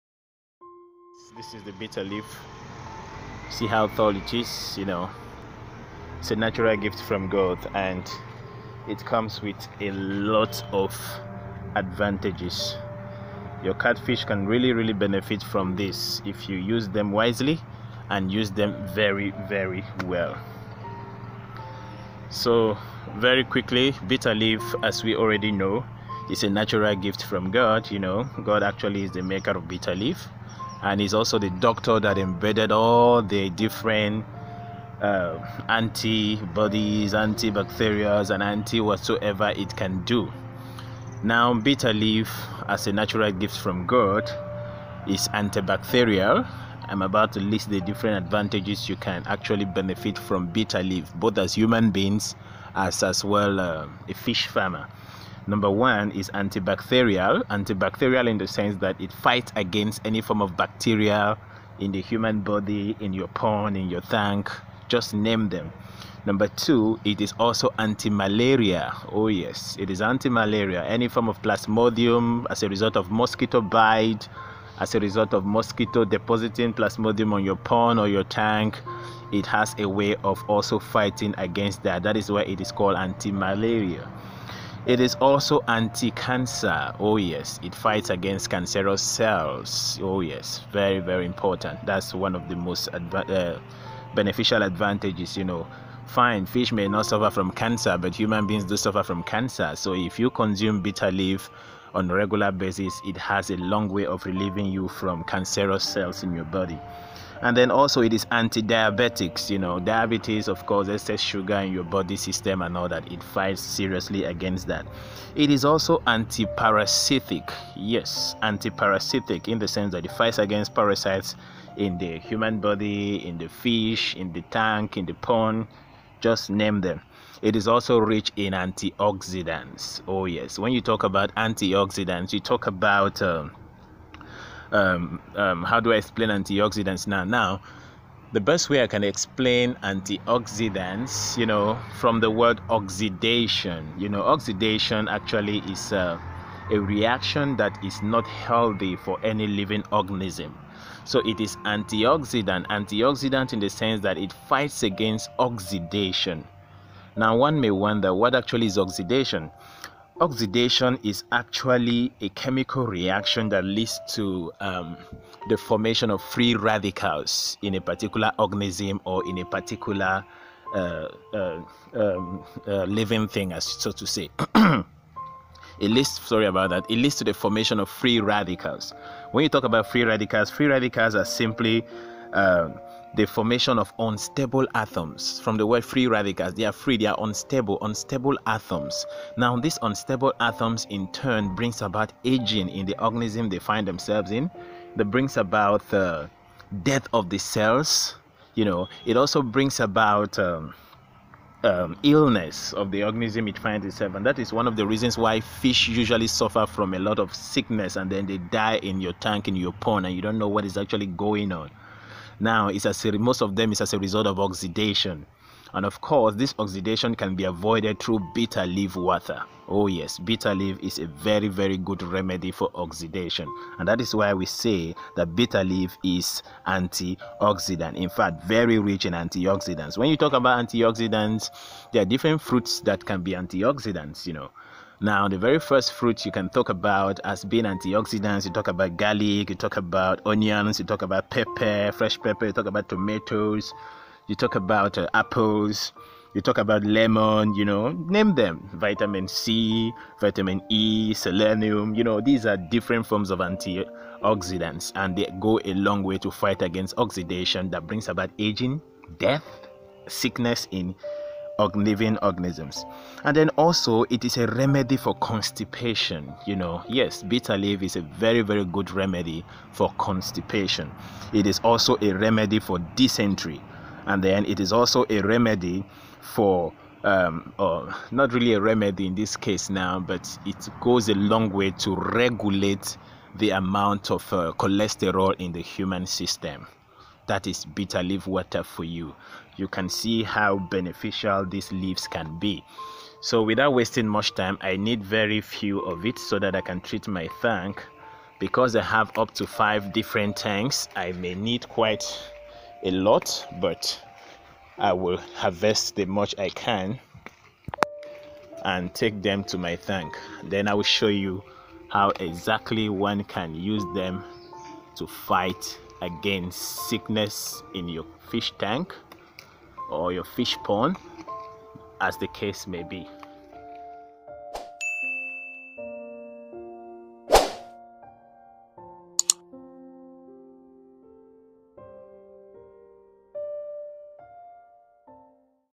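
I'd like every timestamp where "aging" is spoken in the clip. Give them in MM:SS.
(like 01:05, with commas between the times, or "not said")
03:12, 04:18.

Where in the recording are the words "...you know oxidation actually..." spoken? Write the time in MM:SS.
02:23.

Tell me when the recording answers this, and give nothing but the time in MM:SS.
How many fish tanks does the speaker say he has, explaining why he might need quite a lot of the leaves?
04:59.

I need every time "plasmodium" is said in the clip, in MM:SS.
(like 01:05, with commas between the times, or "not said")
01:11, 01:16.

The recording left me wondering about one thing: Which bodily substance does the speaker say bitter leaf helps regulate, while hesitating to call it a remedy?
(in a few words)
cholesterol.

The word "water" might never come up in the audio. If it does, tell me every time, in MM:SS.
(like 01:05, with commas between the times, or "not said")
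03:38, 04:48.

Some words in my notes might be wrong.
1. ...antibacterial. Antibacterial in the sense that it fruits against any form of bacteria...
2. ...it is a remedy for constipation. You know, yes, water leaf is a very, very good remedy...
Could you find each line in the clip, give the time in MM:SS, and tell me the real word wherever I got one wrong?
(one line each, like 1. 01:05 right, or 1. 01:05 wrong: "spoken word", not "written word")
1. 00:56 wrong: "fights", not "fruits"
2. 04:24 wrong: "bitter", not "water".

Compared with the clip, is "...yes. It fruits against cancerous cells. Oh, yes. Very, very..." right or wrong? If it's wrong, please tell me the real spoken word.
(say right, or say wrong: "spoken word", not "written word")
wrong: "fights", not "fruits".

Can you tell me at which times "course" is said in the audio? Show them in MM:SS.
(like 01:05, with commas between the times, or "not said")
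01:50, 03:36.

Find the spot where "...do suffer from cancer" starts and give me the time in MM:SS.
01:38.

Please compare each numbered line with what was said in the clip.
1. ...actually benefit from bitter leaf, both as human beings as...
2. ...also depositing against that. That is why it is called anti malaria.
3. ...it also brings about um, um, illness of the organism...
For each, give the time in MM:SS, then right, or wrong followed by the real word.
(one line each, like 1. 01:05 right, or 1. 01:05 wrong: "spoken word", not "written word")
1. 00:49 right
2. 01:20 wrong: "fighting", not "depositing"
3. 03:19 right.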